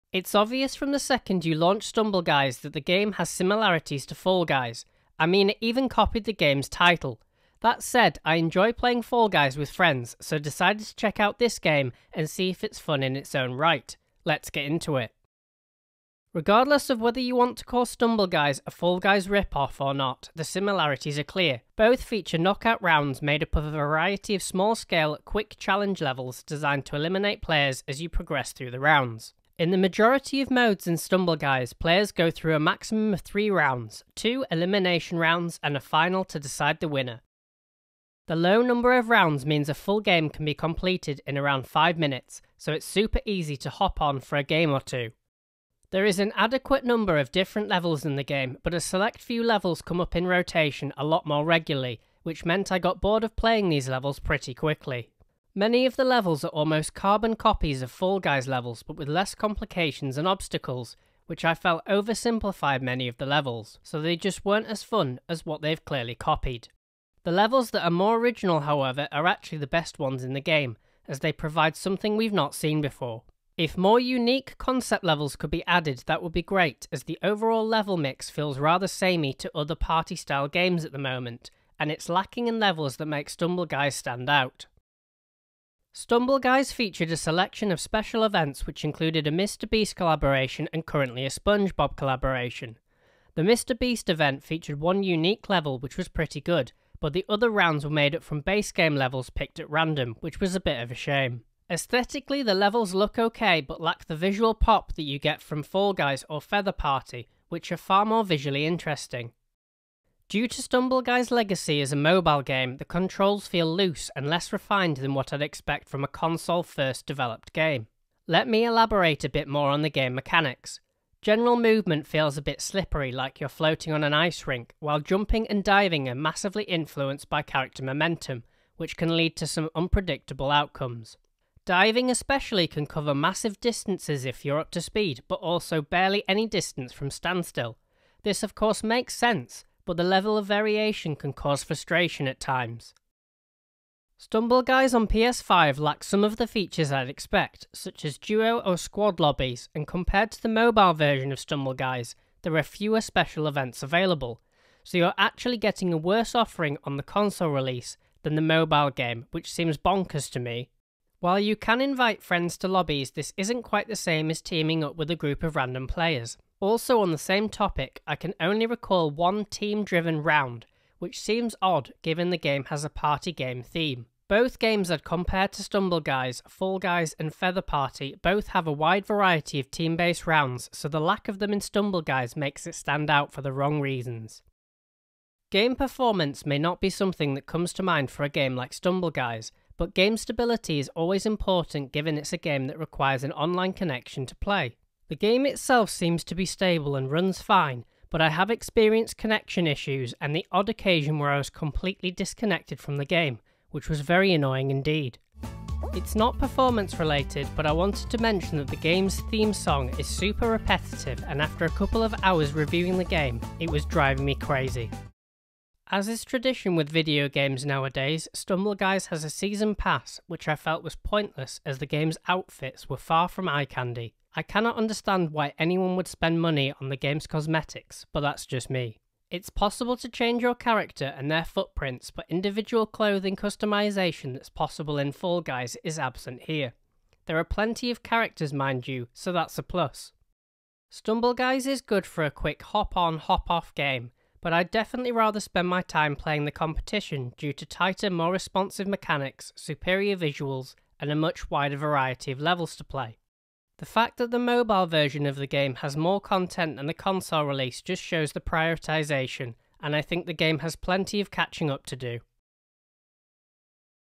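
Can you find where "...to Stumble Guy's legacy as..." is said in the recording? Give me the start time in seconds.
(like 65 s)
110 s.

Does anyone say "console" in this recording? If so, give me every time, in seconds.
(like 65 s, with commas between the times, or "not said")
116 s, 157 s, 256 s.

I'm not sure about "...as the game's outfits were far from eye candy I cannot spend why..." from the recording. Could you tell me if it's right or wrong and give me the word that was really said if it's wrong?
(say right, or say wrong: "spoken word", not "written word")
wrong: "understand", not "spend".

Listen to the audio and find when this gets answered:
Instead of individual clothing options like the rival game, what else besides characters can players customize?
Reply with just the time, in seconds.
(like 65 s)
231 s.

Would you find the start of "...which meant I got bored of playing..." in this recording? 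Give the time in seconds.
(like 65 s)
52 s.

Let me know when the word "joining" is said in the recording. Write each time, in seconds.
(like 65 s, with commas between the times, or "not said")
not said.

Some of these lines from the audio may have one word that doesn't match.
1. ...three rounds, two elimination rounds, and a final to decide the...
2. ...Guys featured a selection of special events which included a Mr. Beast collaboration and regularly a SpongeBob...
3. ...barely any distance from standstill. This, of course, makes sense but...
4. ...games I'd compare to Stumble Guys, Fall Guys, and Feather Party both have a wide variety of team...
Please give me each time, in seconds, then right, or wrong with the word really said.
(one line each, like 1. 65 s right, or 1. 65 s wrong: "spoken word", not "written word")
1. 33 s right
2. 86 s wrong: "currently", not "regularly"
3. 135 s right
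4. 174 s right.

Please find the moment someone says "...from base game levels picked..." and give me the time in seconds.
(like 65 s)
98 s.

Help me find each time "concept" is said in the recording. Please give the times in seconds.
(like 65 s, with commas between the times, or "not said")
74 s.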